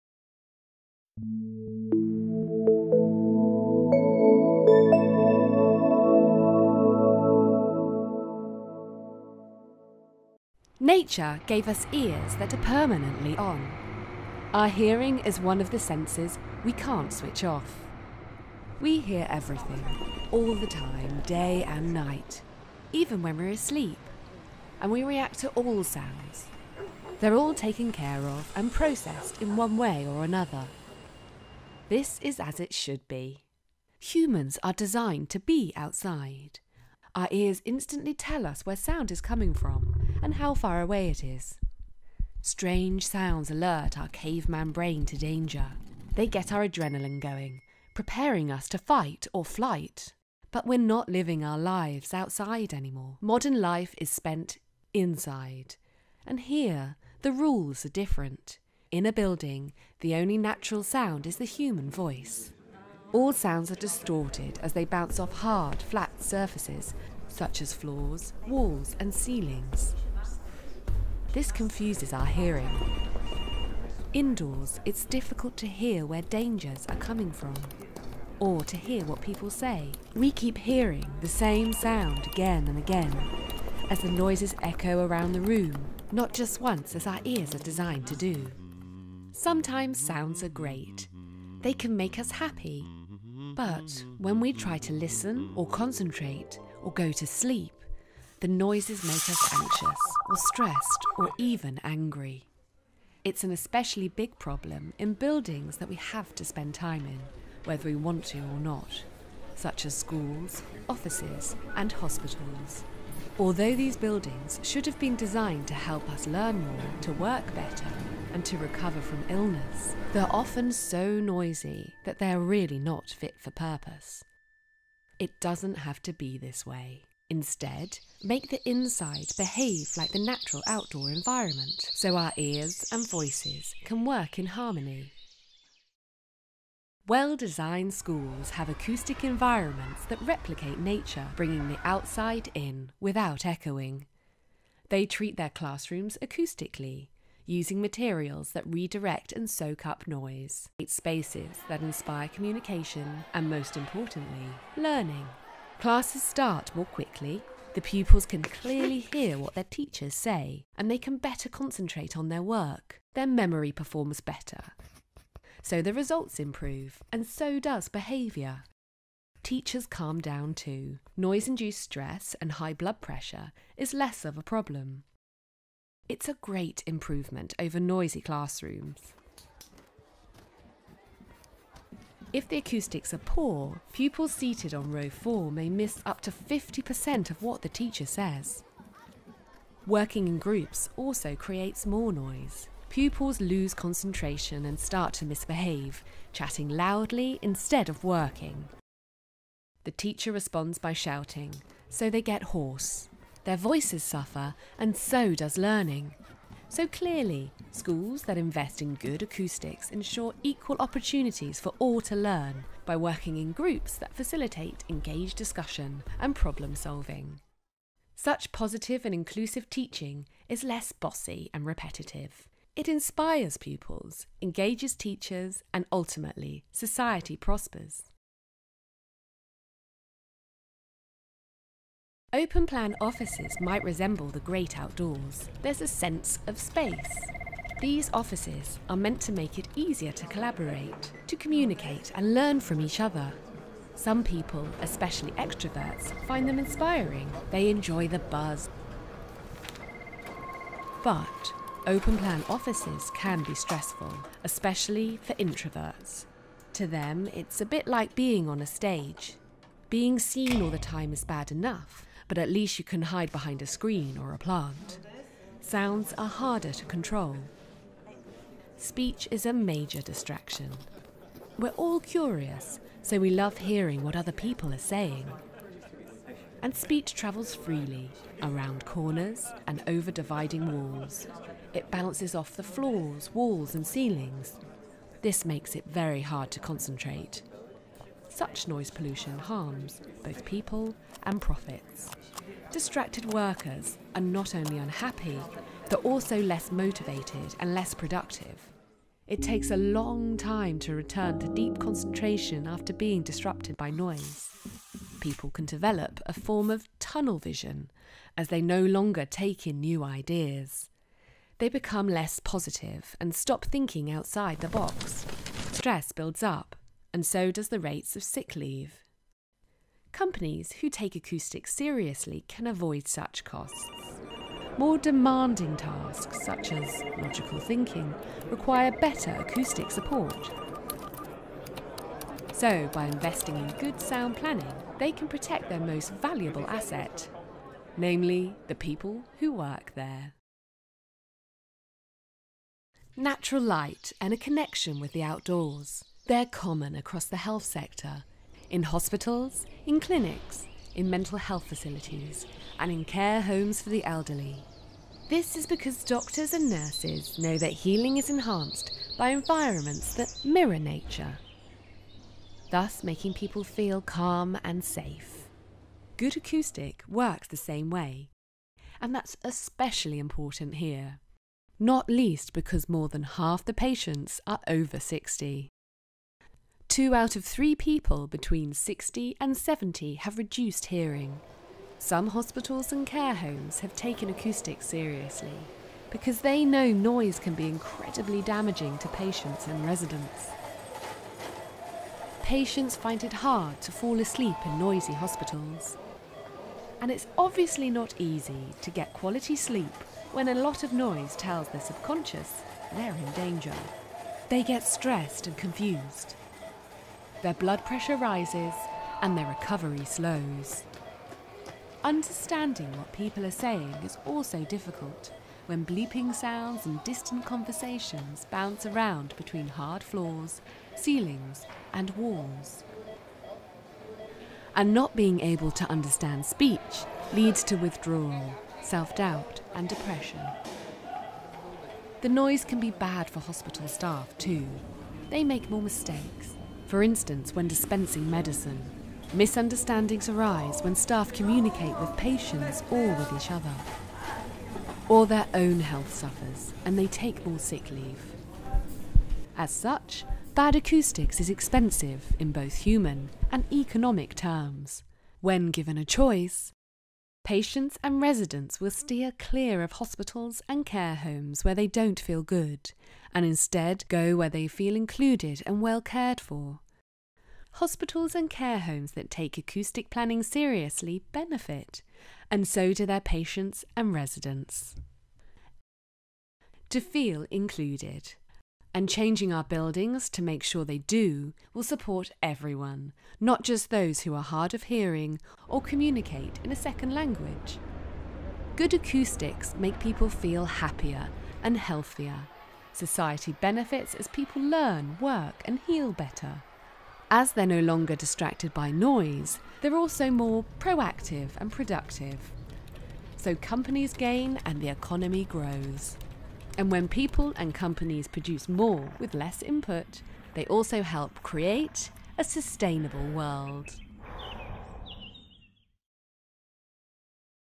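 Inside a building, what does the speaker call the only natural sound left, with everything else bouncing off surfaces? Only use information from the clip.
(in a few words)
the human voice.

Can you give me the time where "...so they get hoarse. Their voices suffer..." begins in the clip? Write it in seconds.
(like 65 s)
201 s.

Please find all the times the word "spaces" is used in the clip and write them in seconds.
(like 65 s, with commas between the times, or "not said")
150 s, 236 s.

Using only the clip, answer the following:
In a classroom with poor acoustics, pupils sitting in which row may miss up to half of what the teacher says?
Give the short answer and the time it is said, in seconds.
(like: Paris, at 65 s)
row 4, at 184 s.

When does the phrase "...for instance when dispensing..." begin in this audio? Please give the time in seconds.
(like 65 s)
436 s.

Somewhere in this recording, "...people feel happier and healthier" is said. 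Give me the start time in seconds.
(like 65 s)
490 s.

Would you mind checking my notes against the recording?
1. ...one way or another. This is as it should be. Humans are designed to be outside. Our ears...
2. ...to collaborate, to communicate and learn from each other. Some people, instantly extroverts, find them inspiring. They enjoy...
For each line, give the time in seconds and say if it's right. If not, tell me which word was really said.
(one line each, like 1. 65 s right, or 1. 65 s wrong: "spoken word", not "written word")
1. 29 s right
2. 240 s wrong: "especially", not "instantly".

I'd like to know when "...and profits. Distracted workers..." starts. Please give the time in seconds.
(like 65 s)
291 s.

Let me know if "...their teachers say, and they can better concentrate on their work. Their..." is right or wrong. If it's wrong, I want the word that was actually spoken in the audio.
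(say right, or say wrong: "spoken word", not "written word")
right.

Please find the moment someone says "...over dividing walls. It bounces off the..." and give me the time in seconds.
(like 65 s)
279 s.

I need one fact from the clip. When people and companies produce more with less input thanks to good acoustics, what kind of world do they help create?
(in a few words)
a sustainable world.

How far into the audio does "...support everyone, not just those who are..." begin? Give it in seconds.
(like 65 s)
481 s.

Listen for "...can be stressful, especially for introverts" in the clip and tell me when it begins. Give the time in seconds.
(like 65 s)
253 s.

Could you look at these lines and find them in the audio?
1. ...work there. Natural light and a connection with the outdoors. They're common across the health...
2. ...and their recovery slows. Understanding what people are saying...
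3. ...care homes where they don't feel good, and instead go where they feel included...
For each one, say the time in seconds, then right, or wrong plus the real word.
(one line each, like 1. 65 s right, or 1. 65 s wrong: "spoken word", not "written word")
1. 339 s right
2. 409 s right
3. 460 s right.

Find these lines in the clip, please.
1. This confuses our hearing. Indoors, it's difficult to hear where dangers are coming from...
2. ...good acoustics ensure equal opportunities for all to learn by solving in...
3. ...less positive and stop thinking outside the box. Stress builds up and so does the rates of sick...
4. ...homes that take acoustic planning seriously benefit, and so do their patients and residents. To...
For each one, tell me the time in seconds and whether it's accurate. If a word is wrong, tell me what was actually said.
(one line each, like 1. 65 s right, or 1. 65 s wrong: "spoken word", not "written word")
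1. 71 s right
2. 208 s wrong: "working", not "solving"
3. 312 s right
4. 468 s right.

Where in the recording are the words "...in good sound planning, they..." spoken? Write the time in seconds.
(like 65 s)
333 s.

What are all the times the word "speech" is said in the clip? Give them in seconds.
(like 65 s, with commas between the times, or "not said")
268 s, 276 s, 426 s.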